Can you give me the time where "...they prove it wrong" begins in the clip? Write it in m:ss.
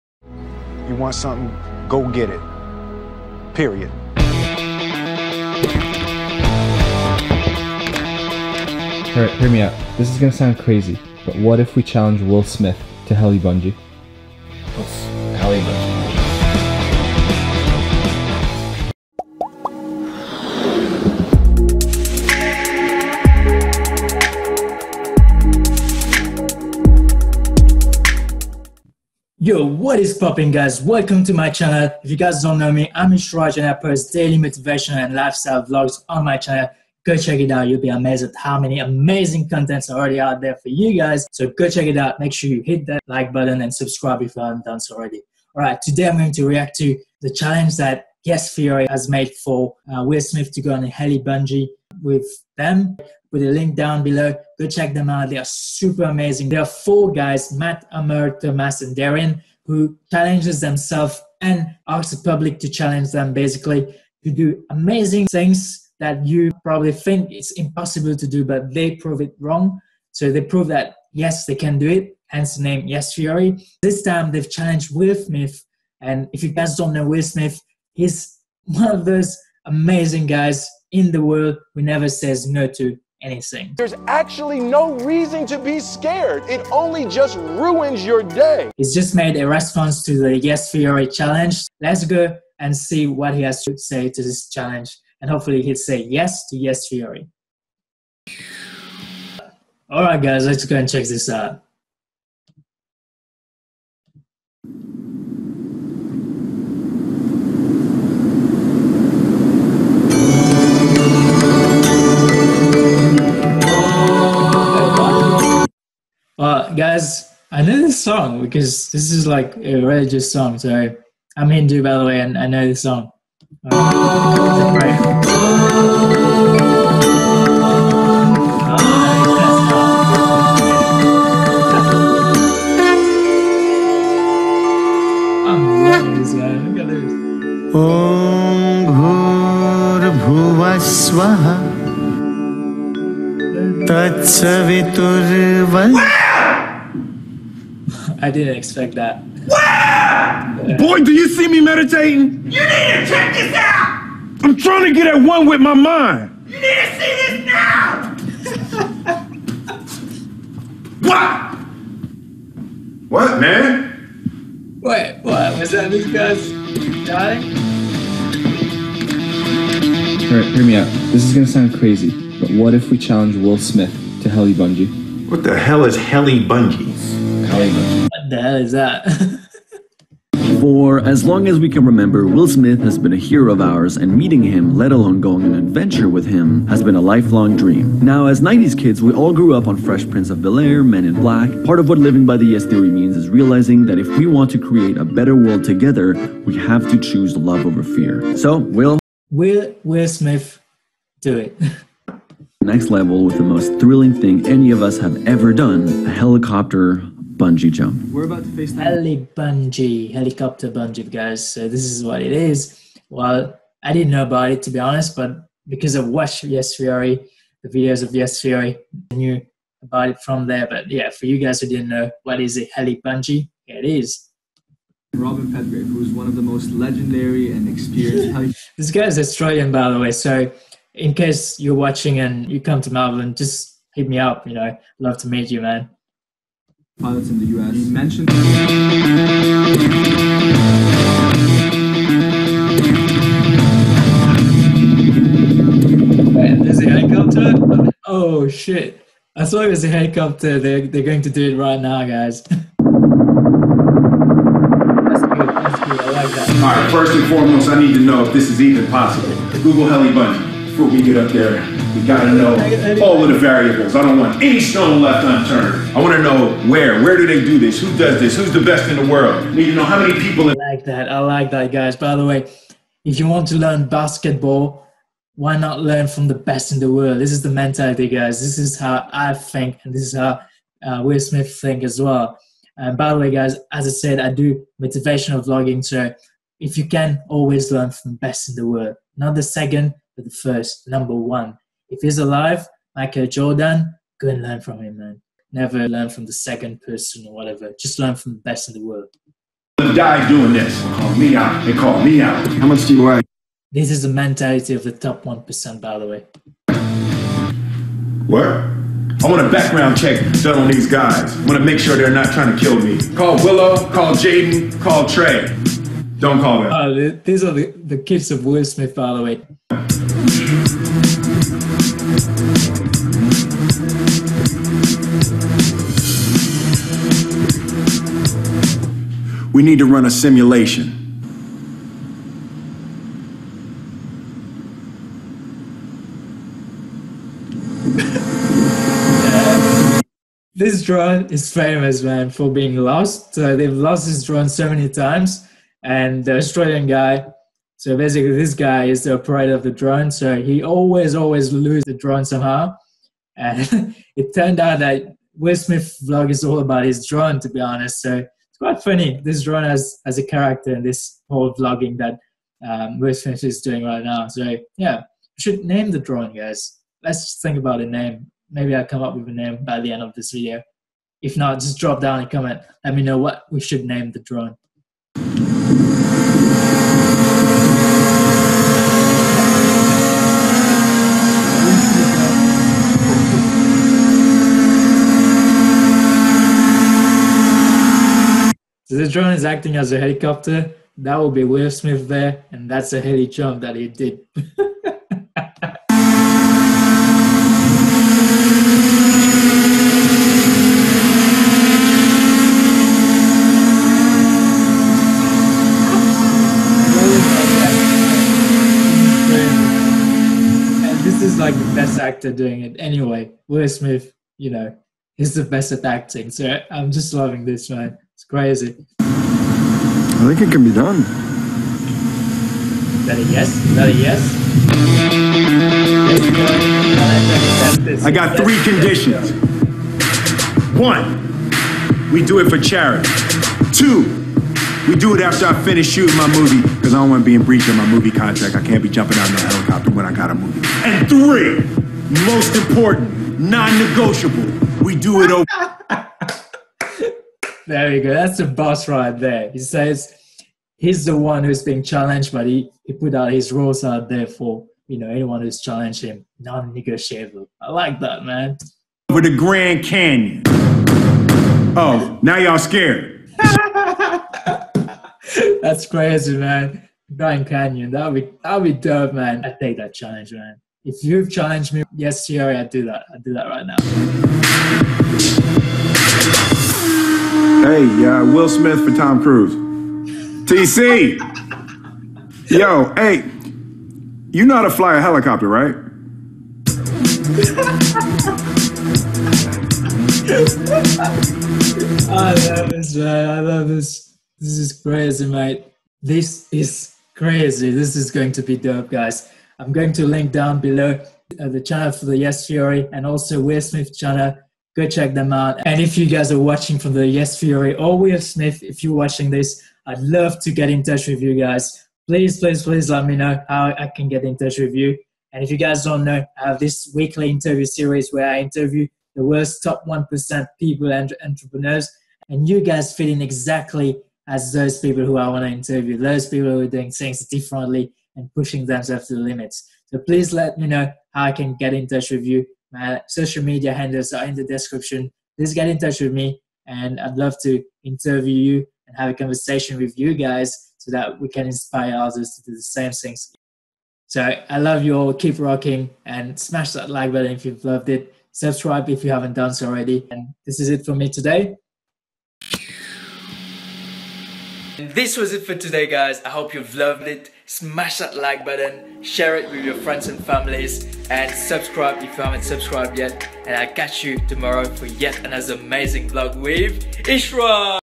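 1:08.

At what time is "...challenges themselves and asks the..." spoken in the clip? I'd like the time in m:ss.
1:00.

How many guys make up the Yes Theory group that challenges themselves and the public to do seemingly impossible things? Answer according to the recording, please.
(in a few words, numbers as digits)
4.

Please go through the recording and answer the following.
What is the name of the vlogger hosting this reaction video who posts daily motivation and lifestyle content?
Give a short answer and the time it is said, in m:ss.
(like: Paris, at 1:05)
Ishraj, at 0:33.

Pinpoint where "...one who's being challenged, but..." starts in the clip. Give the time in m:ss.
7:31.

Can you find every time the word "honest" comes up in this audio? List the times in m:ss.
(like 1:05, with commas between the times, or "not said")
3:34, 5:57.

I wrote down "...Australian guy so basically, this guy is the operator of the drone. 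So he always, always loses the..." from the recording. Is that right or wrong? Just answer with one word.
right.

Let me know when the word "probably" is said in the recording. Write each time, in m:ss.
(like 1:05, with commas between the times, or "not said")
1:06.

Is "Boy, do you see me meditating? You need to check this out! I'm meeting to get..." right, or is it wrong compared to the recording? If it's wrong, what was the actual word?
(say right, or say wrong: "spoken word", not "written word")
wrong: "trying", not "meeting".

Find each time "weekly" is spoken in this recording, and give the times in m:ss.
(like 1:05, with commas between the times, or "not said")
8:36.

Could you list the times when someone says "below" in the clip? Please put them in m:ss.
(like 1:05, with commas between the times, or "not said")
0:54, 8:20.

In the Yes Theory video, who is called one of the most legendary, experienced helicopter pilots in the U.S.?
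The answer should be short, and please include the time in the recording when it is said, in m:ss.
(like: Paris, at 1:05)
Robin Petgrave, at 3:45.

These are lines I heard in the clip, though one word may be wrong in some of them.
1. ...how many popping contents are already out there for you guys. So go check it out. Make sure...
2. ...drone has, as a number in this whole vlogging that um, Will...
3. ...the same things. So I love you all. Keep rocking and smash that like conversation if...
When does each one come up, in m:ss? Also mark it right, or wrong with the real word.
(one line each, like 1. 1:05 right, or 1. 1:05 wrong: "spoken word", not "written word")
1. 0:38 wrong: "amazing", not "popping"
2. 5:59 wrong: "character", not "number"
3. 9:02 wrong: "button", not "conversation".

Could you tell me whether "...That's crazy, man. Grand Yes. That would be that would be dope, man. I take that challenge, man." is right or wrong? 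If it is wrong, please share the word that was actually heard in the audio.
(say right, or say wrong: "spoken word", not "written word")
wrong: "Canyon", not "Yes".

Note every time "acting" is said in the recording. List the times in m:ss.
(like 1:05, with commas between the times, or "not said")
6:29, 6:55.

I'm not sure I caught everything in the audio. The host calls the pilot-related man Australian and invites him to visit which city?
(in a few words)
Melbourne.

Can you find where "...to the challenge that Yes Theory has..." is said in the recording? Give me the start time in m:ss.
0:46.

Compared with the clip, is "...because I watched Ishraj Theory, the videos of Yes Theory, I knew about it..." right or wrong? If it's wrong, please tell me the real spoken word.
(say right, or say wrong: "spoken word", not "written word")
wrong: "Yes", not "Ishraj".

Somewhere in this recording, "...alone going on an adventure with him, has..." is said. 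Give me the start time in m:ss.
3:04.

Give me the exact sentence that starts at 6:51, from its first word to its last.
is like the best actor doing it anyway.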